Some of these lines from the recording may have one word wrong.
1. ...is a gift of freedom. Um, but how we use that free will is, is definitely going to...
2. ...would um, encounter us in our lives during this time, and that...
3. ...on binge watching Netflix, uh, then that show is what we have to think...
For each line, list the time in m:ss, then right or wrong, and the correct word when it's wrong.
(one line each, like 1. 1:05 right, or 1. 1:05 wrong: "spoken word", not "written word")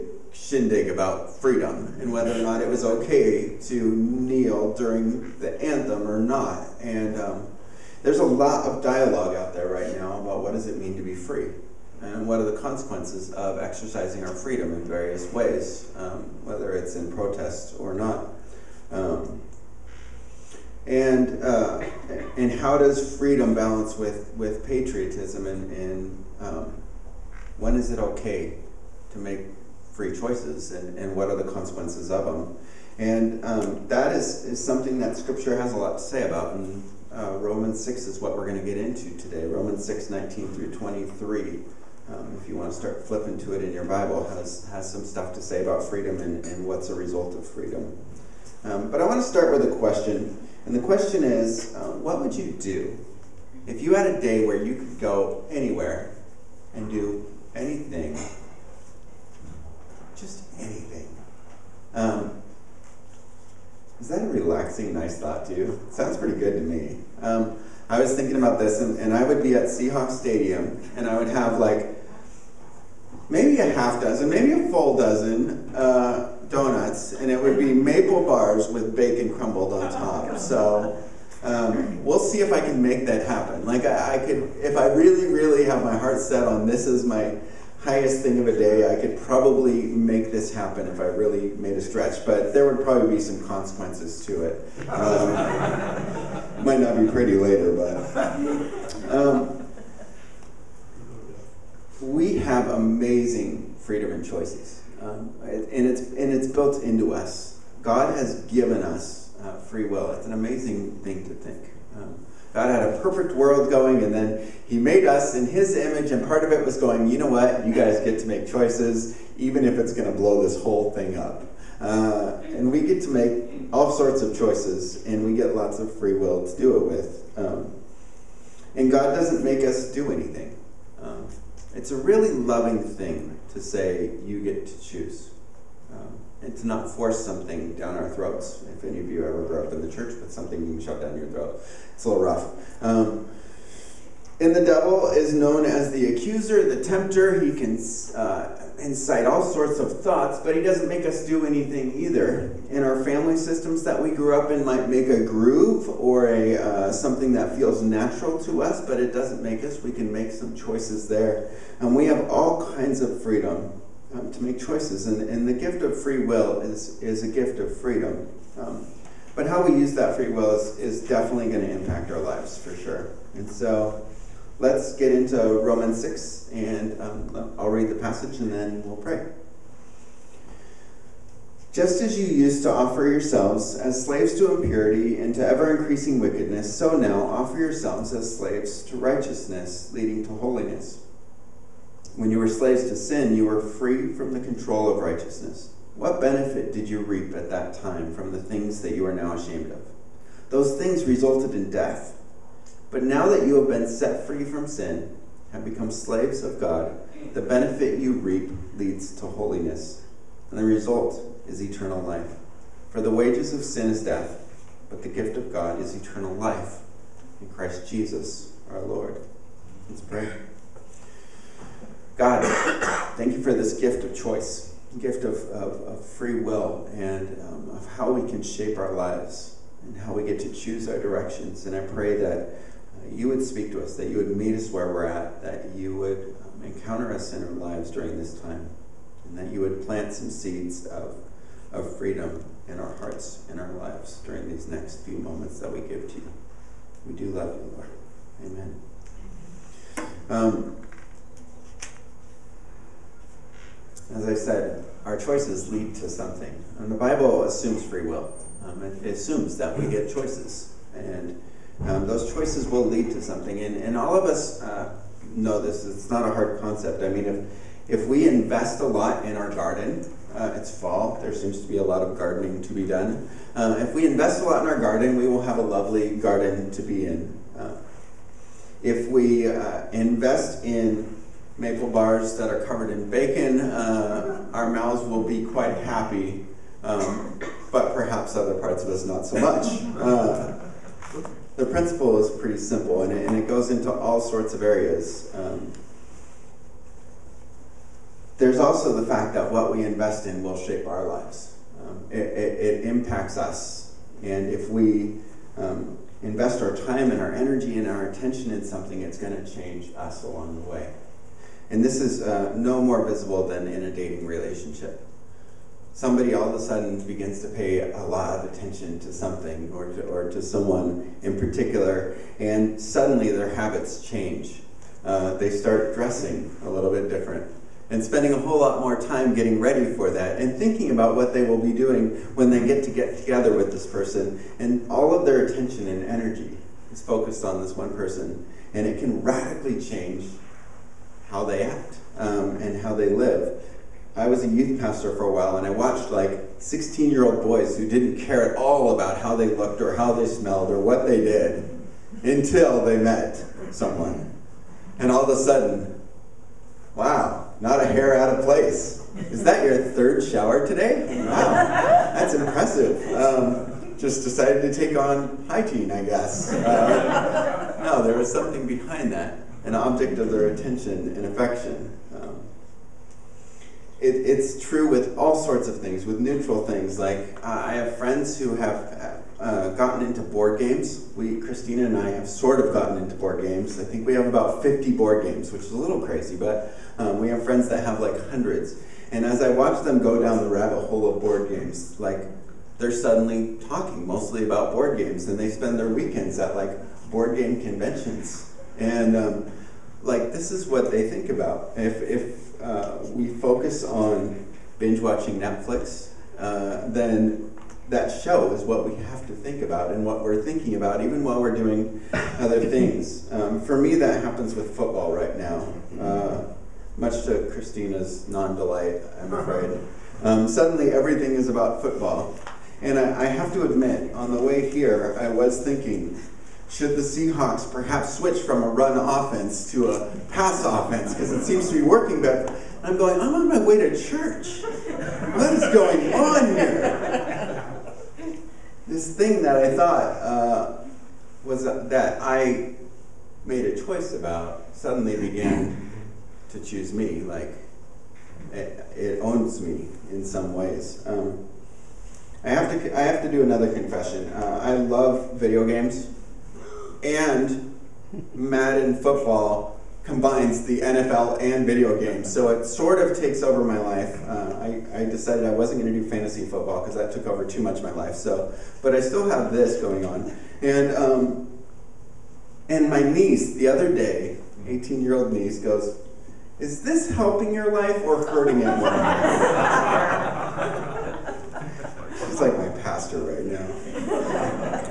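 1. 2:47 right
2. 3:55 right
3. 6:43 right.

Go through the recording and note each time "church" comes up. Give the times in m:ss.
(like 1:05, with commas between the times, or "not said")
2:19, 7:13.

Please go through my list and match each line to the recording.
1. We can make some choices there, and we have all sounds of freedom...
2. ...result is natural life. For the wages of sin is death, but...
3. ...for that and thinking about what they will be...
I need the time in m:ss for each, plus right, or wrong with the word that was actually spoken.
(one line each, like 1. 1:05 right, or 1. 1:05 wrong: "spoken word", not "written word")
1. 2:39 wrong: "kinds", not "sounds"
2. 3:30 wrong: "eternal", not "natural"
3. 5:29 right.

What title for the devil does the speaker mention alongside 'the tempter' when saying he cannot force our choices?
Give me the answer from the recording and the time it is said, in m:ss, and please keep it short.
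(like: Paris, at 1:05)
the accuser, at 2:25.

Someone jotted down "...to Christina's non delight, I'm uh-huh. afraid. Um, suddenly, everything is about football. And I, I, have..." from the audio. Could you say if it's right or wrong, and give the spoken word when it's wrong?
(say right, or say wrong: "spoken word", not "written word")
right.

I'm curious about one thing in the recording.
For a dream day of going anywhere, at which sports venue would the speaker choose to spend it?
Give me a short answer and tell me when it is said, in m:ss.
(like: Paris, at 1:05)
Seahawks Stadium, at 1:09.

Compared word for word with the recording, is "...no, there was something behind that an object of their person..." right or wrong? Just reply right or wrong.
wrong.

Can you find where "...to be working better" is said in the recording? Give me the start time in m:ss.
7:11.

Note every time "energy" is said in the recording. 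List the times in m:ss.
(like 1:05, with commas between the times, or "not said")
5:07, 5:36.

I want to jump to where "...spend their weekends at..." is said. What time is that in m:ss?
6:35.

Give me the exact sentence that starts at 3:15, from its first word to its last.
What benefit did you reap at that time from the things that you are now ashamed of?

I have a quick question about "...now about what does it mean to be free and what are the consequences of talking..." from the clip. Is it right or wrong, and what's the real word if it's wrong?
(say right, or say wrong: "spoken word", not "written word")
wrong: "exercising", not "talking".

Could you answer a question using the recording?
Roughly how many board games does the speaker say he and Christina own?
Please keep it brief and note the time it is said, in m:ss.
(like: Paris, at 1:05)
50, at 6:24.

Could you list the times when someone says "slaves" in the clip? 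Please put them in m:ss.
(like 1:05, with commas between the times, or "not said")
3:04, 3:08, 3:12, 3:25.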